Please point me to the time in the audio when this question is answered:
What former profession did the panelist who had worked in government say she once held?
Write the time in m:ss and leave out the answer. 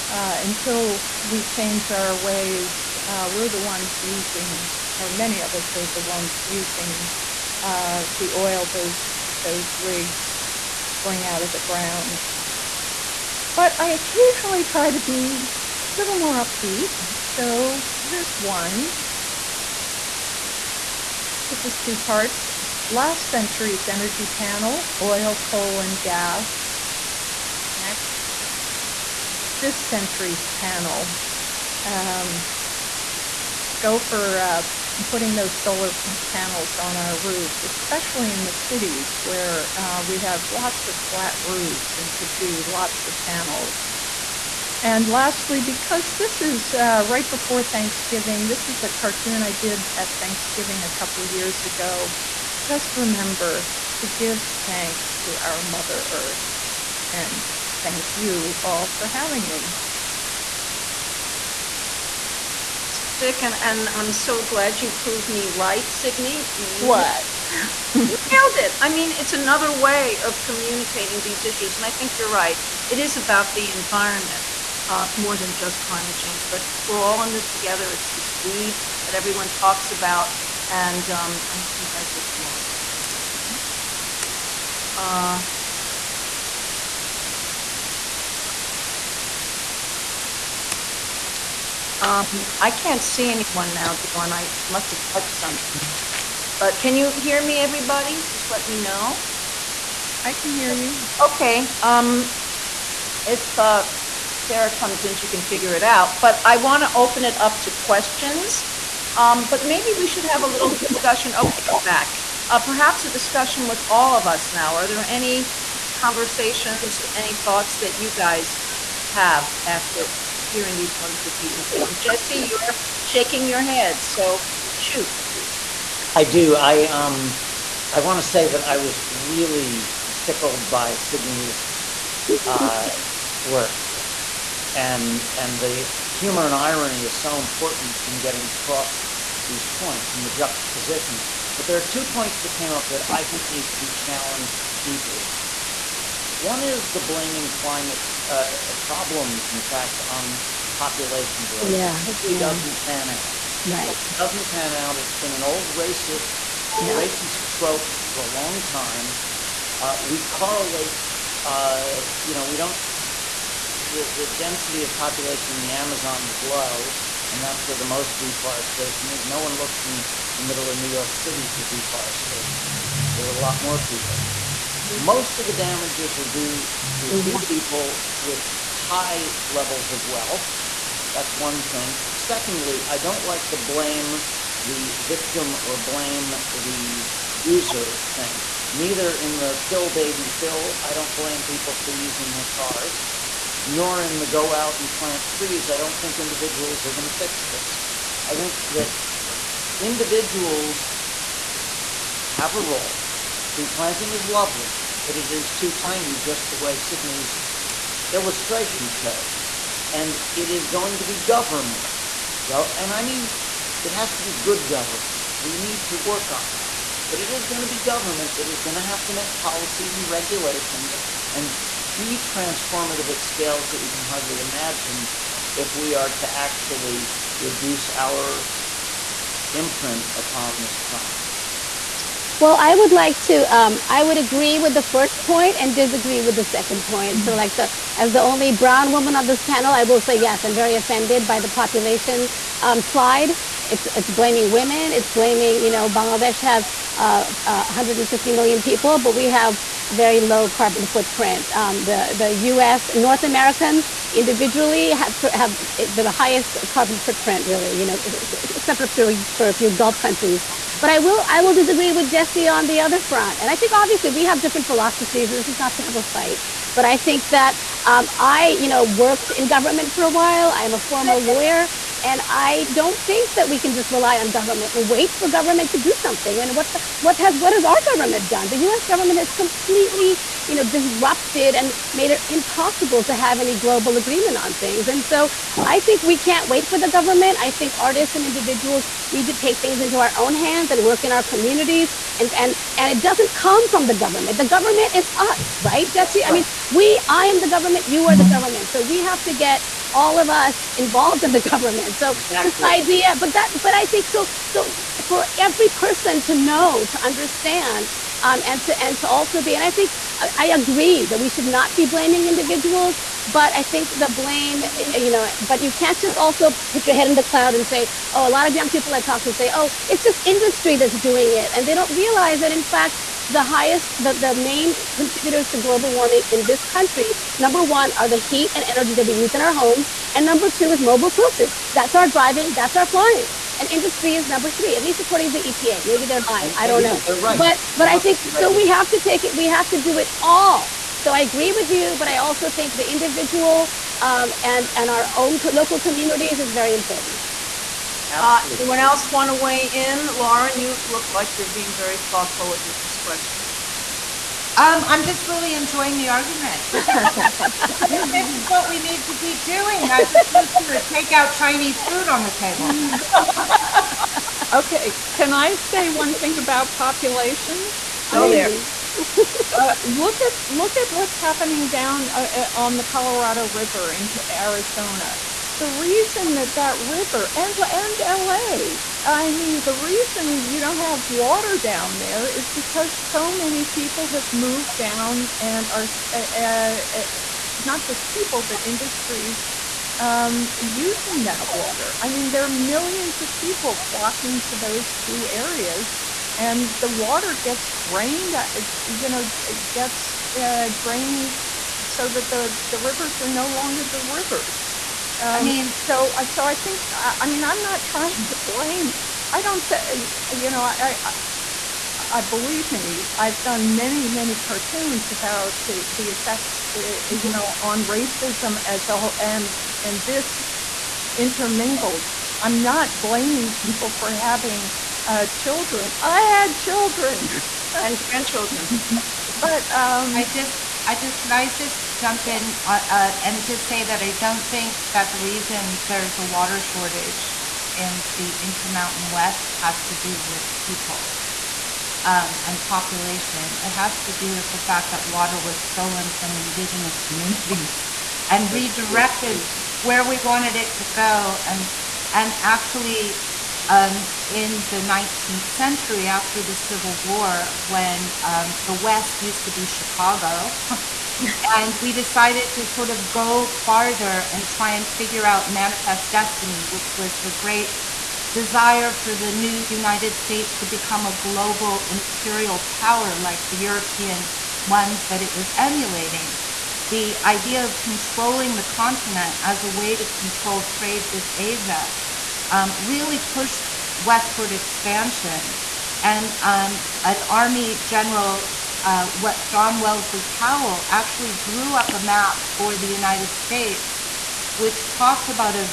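4:31.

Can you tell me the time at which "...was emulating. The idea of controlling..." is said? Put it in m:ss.
7:55.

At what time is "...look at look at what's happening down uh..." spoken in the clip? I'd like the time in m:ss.
6:09.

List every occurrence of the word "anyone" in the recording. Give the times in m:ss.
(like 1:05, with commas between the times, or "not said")
1:33, 5:48.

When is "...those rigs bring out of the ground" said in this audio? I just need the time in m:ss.
0:09.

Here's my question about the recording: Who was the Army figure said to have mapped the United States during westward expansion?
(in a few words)
John Wellesley Powell.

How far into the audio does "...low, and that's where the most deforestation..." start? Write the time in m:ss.
2:46.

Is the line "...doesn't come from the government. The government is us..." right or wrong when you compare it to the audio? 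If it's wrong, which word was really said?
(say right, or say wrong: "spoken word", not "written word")
right.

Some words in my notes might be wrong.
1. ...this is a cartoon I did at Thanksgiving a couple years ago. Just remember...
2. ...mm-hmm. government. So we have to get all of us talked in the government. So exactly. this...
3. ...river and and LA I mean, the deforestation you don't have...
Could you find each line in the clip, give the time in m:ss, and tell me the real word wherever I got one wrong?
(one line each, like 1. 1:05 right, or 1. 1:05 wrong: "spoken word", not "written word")
1. 0:48 right
2. 4:58 wrong: "involved", not "talked"
3. 6:16 wrong: "reason", not "deforestation".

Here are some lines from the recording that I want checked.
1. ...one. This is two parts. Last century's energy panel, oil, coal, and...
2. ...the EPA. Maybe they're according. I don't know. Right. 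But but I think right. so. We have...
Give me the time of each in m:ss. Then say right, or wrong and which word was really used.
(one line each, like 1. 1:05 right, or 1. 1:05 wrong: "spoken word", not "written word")
1. 0:18 right
2. 5:35 wrong: "lying", not "according".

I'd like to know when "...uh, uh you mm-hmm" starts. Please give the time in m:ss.
6:56.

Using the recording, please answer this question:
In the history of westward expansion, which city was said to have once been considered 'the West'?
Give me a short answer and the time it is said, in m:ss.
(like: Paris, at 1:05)
Chicago, at 7:39.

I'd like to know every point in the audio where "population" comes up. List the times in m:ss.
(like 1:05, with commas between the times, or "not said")
2:30, 2:44, 4:01, 6:06, 7:22.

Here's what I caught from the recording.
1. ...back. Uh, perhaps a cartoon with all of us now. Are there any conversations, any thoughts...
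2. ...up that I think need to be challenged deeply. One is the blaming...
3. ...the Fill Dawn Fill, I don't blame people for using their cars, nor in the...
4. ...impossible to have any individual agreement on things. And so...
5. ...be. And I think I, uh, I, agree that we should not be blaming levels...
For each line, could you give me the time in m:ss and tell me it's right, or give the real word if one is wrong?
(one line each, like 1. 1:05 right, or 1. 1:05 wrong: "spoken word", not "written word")
1. 1:51 wrong: "discussion", not "cartoon"
2. 2:22 right
3. 3:09 wrong: "Baby", not "Dawn"
4. 4:42 wrong: "global", not "individual"
5. 5:09 wrong: "individuals", not "levels".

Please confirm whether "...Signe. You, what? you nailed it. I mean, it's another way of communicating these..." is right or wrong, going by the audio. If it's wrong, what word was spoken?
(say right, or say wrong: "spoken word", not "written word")
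right.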